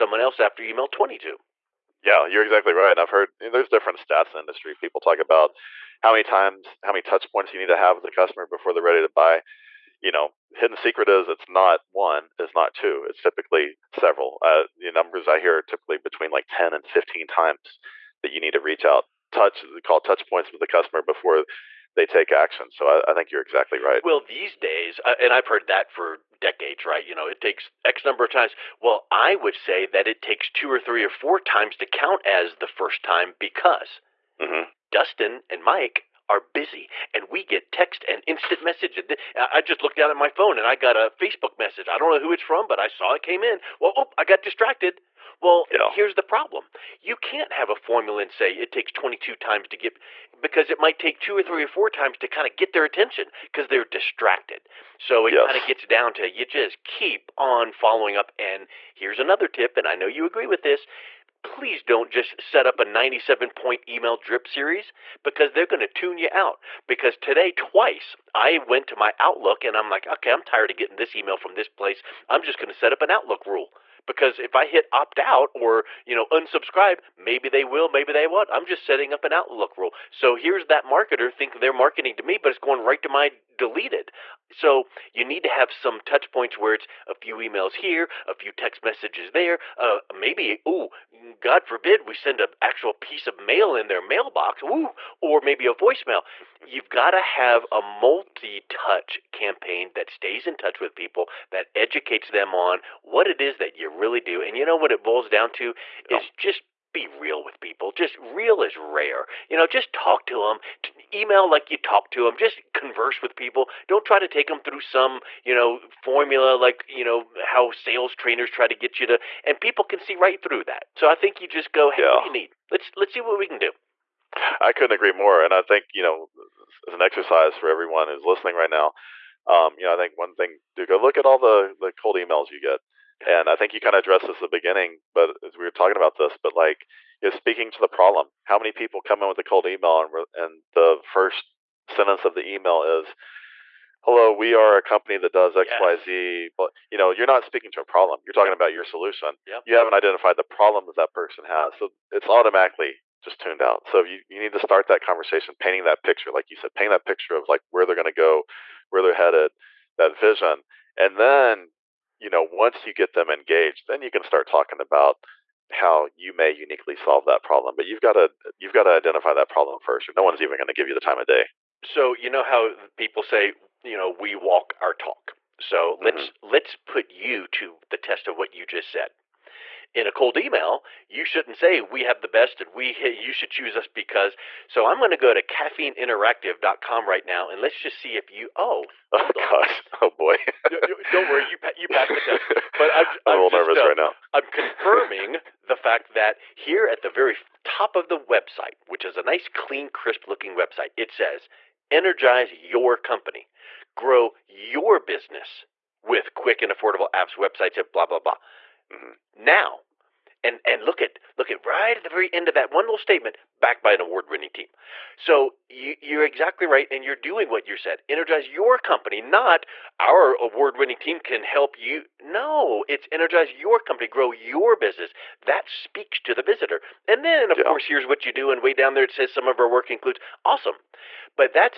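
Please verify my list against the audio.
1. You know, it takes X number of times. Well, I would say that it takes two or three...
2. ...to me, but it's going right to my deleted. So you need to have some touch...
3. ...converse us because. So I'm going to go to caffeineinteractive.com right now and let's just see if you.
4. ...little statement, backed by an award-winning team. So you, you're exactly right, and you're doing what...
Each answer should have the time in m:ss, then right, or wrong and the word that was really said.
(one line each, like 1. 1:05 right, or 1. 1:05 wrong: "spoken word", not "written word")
1. 0:27 right
2. 1:22 right
3. 3:03 wrong: "choose", not "converse"
4. 3:32 right.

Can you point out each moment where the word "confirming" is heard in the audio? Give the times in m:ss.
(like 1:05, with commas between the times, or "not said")
3:14.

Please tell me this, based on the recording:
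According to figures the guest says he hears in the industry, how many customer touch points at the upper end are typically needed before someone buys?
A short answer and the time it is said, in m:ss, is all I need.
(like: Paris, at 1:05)
15, at 0:16.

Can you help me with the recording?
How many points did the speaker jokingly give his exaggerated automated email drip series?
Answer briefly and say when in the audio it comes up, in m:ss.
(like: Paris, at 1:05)
97, at 1:02.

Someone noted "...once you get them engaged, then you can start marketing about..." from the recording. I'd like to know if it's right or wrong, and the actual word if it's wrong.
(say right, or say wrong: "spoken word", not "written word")
wrong: "talking", not "marketing".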